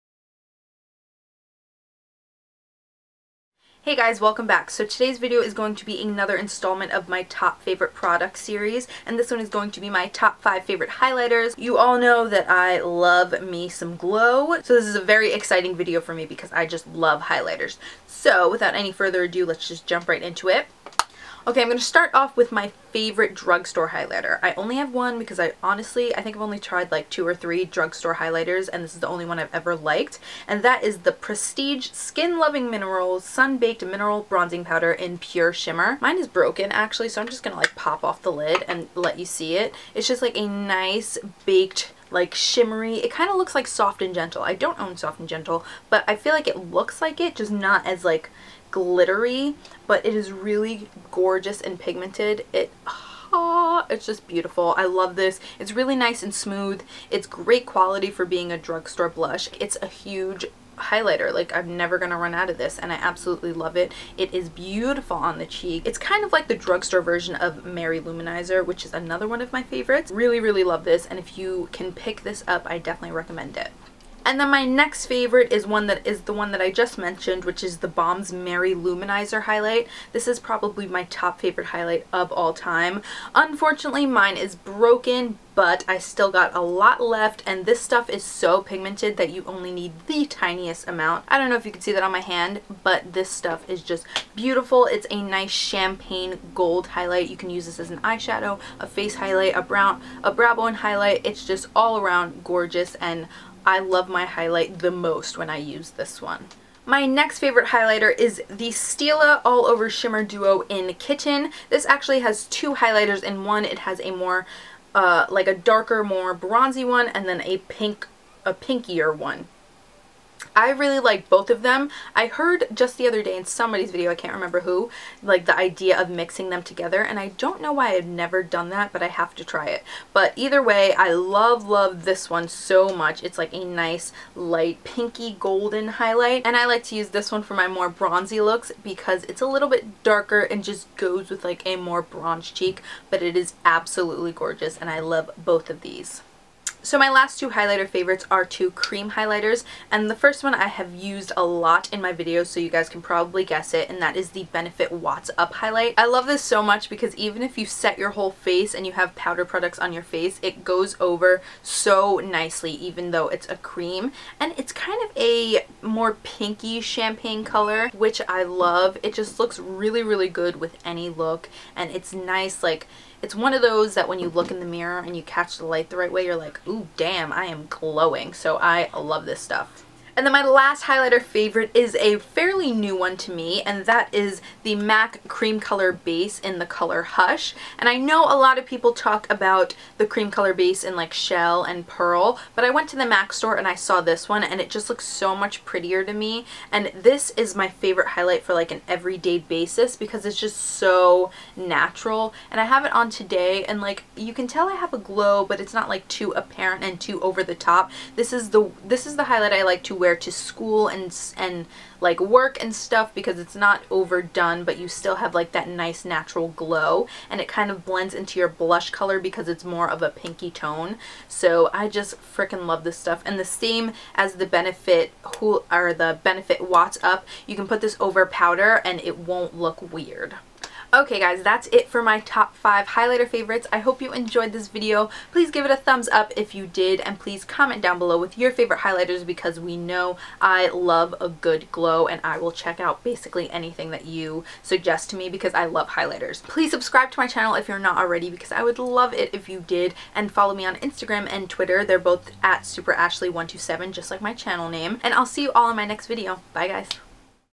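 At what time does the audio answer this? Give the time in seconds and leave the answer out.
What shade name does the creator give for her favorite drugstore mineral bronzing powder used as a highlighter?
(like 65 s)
35 s.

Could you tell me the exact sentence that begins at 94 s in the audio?
It's a nice champagne gold highlight.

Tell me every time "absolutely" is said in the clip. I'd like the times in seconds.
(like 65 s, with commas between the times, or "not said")
62 s, 143 s.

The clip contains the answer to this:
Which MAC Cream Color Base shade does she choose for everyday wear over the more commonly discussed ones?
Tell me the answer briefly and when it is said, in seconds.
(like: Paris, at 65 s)
Hush, at 187 s.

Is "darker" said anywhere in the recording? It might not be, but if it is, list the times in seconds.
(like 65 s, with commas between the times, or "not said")
115 s, 140 s.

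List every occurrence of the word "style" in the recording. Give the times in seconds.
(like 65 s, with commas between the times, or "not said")
not said.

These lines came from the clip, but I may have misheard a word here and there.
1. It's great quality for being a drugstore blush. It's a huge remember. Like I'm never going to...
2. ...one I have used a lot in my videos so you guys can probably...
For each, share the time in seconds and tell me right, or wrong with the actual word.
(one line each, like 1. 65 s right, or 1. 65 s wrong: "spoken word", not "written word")
1. 57 s wrong: "highlighter", not "remember"
2. 150 s right.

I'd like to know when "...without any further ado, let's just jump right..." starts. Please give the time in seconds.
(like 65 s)
18 s.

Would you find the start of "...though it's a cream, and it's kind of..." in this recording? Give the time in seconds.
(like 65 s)
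163 s.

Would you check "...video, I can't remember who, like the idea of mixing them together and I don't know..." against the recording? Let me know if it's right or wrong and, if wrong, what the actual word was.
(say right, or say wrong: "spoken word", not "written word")
right.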